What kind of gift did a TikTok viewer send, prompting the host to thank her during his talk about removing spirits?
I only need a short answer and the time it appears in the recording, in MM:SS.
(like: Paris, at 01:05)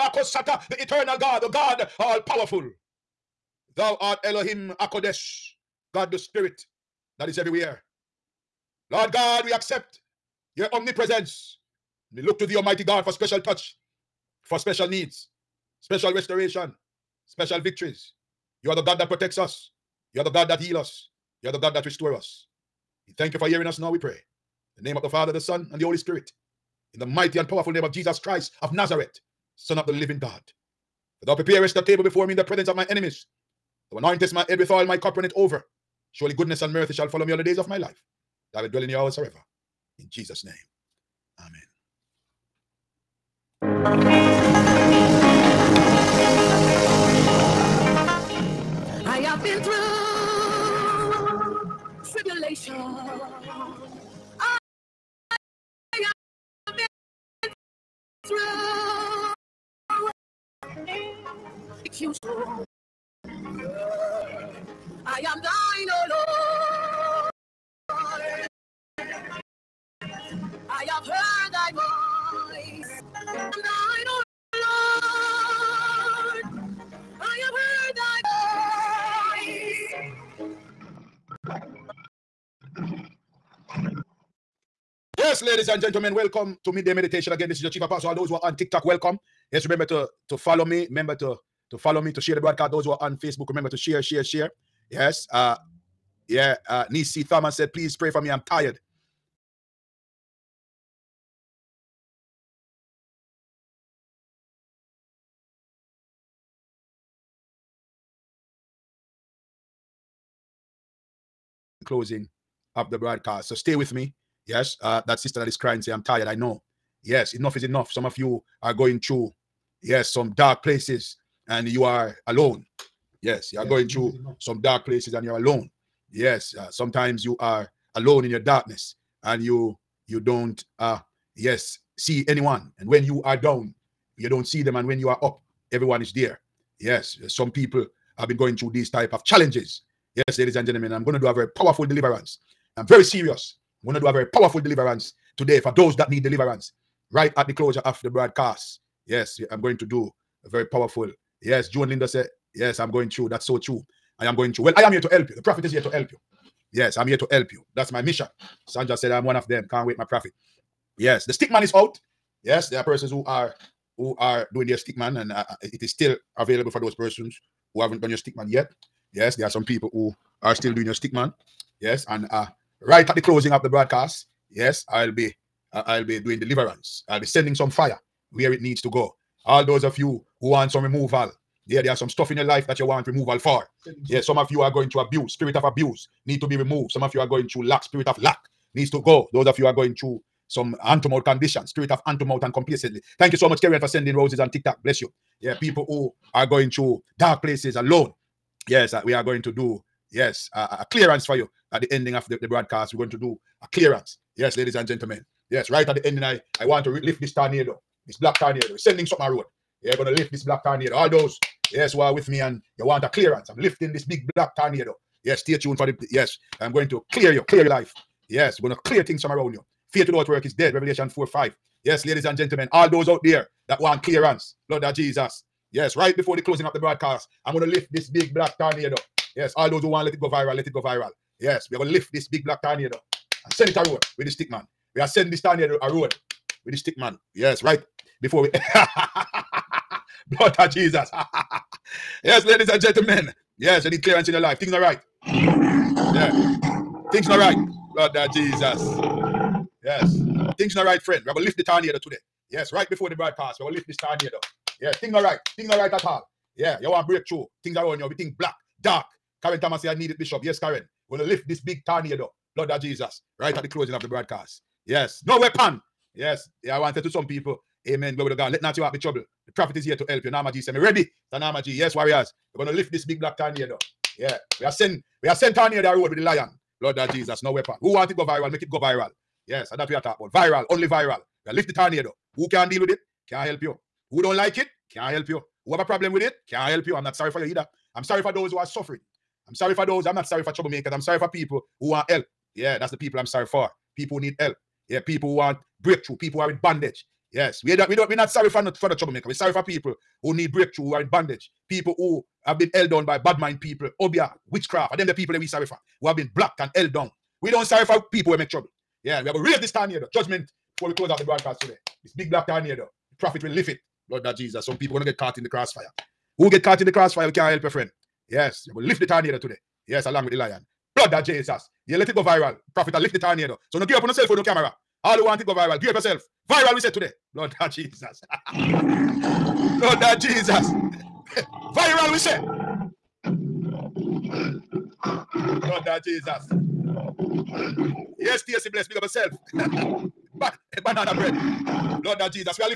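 Roses, at 03:14.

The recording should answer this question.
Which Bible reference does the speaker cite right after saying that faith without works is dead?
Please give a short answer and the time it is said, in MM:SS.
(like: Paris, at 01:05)
Revelation 4:5, at 03:40.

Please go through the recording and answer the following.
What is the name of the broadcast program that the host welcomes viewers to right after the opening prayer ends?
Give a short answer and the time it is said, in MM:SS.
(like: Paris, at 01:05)
Midday Meditation, at 01:26.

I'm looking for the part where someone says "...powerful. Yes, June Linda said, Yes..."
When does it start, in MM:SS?
02:30.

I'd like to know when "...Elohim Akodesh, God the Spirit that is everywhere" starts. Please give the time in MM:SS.
00:04.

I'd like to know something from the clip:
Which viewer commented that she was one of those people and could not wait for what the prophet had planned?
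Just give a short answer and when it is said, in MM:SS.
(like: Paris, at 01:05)
Sanja, at 02:38.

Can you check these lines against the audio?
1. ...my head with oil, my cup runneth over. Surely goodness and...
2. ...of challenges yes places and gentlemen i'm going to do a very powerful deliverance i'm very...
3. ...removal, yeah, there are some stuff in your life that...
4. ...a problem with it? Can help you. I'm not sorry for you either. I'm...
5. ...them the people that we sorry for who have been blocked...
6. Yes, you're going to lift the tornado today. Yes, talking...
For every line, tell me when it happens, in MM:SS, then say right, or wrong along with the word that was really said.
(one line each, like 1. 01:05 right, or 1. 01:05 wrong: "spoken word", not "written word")
1. 00:34 right
2. 02:19 wrong: "ladies", not "places"
3. 03:00 right
4. 04:45 right
5. 05:04 right
6. 05:18 wrong: "along", not "talking".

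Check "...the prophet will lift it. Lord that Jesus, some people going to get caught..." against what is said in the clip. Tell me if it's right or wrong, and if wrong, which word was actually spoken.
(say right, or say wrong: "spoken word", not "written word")
right.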